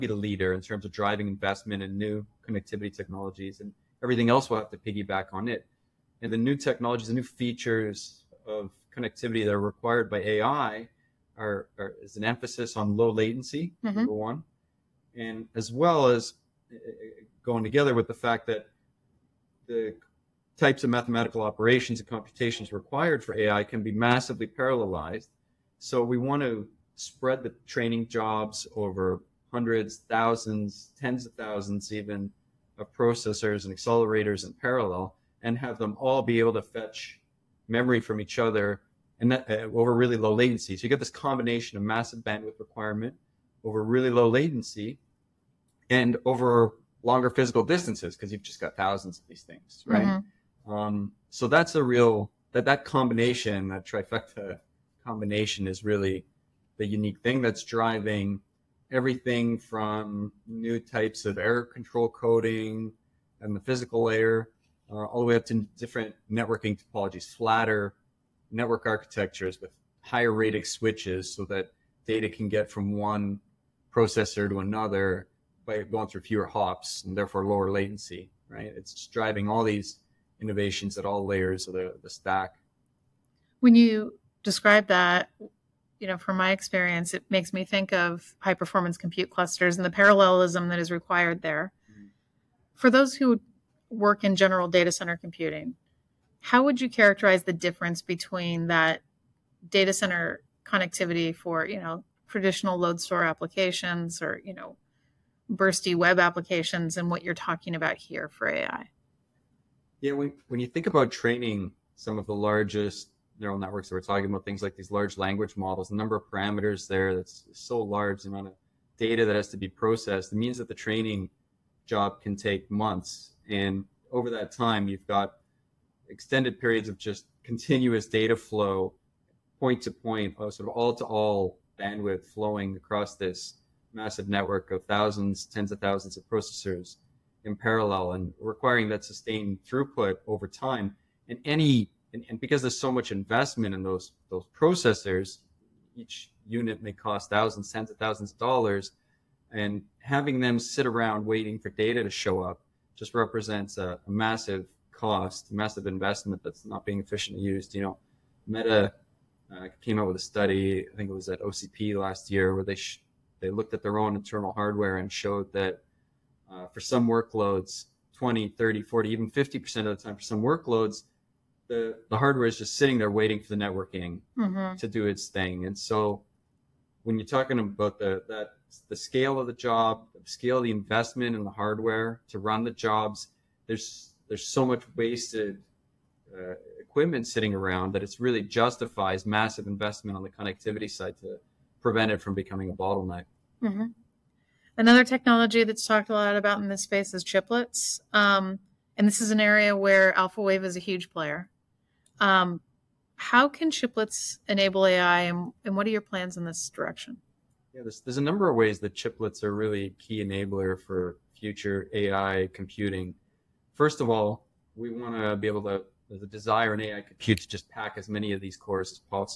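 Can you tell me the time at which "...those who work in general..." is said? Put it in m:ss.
1:32.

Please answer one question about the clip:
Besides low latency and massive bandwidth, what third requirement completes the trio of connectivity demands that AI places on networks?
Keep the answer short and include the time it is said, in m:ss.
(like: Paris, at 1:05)
longer physical distances, at 0:47.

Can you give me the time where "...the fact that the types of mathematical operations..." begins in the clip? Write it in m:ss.
0:18.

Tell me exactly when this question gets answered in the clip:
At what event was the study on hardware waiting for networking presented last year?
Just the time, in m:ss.
2:41.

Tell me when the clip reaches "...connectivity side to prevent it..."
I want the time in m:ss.
3:10.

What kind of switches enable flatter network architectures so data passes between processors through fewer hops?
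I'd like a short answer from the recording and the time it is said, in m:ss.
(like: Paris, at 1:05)
higher radix switches, at 1:09.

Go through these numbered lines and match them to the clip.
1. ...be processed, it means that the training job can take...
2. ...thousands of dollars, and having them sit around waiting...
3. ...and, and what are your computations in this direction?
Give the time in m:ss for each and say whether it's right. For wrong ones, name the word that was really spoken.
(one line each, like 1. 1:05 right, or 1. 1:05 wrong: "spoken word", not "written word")
1. 1:59 right
2. 2:27 right
3. 3:25 wrong: "plans", not "computations".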